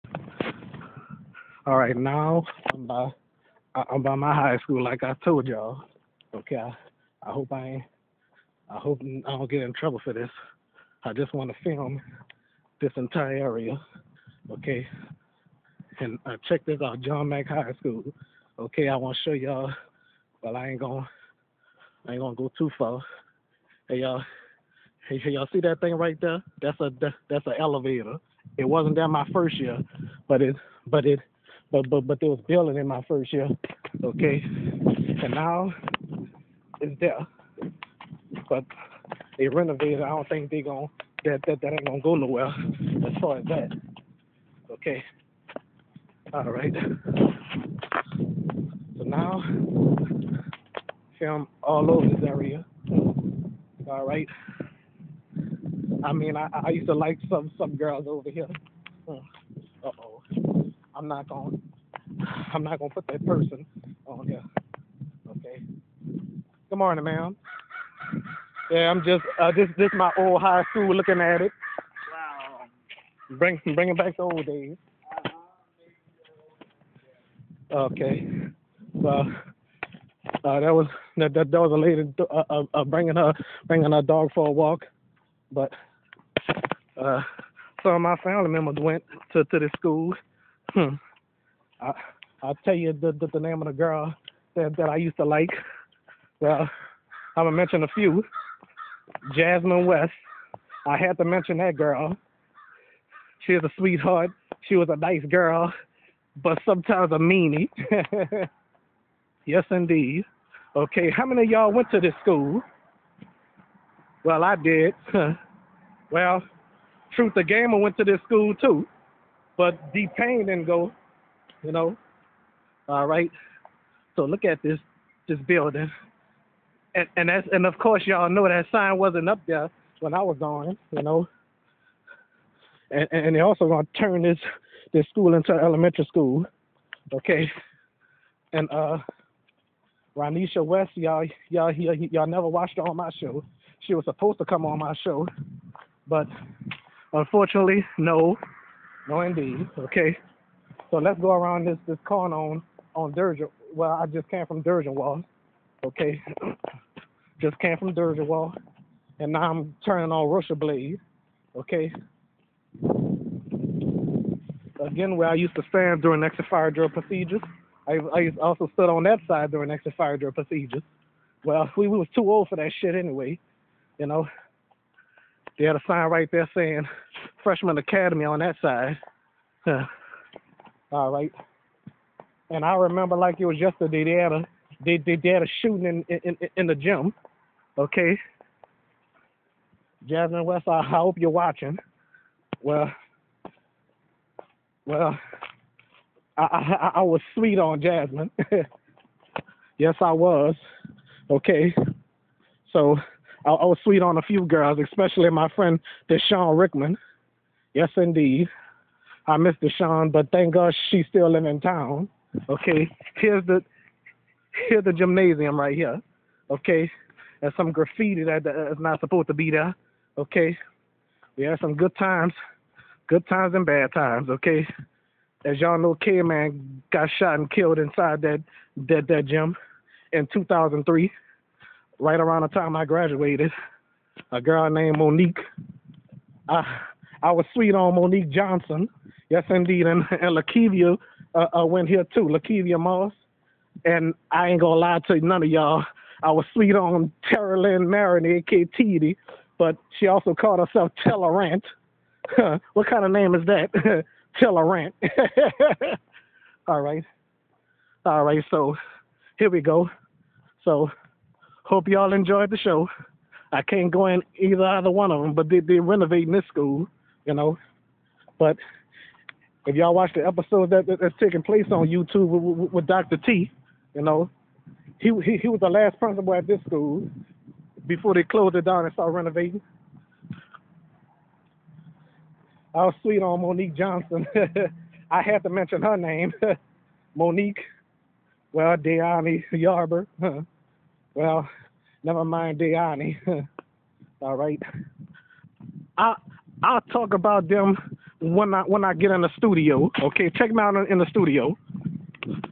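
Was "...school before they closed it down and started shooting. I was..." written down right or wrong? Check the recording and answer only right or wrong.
wrong.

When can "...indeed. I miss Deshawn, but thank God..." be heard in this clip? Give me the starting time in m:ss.
3:27.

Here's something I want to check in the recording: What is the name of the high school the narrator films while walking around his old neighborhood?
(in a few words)
John Mack High School.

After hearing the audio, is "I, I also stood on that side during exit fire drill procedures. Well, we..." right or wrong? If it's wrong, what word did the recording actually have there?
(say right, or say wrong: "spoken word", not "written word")
right.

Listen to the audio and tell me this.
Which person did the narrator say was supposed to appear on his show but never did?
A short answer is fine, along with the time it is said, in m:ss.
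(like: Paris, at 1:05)
Ronisha West, at 2:20.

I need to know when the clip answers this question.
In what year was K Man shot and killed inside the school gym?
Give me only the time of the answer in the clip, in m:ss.
3:50.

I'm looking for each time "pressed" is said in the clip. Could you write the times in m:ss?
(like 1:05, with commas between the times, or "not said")
not said.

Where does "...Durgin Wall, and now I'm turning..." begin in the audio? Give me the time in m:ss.
2:37.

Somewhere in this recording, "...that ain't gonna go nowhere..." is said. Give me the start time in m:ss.
0:41.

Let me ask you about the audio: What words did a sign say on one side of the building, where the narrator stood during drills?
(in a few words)
Freshman academy.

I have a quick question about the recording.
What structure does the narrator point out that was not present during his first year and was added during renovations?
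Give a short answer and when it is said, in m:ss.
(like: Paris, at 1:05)
An elevator, at 0:27.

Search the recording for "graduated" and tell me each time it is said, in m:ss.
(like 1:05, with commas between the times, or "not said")
3:52.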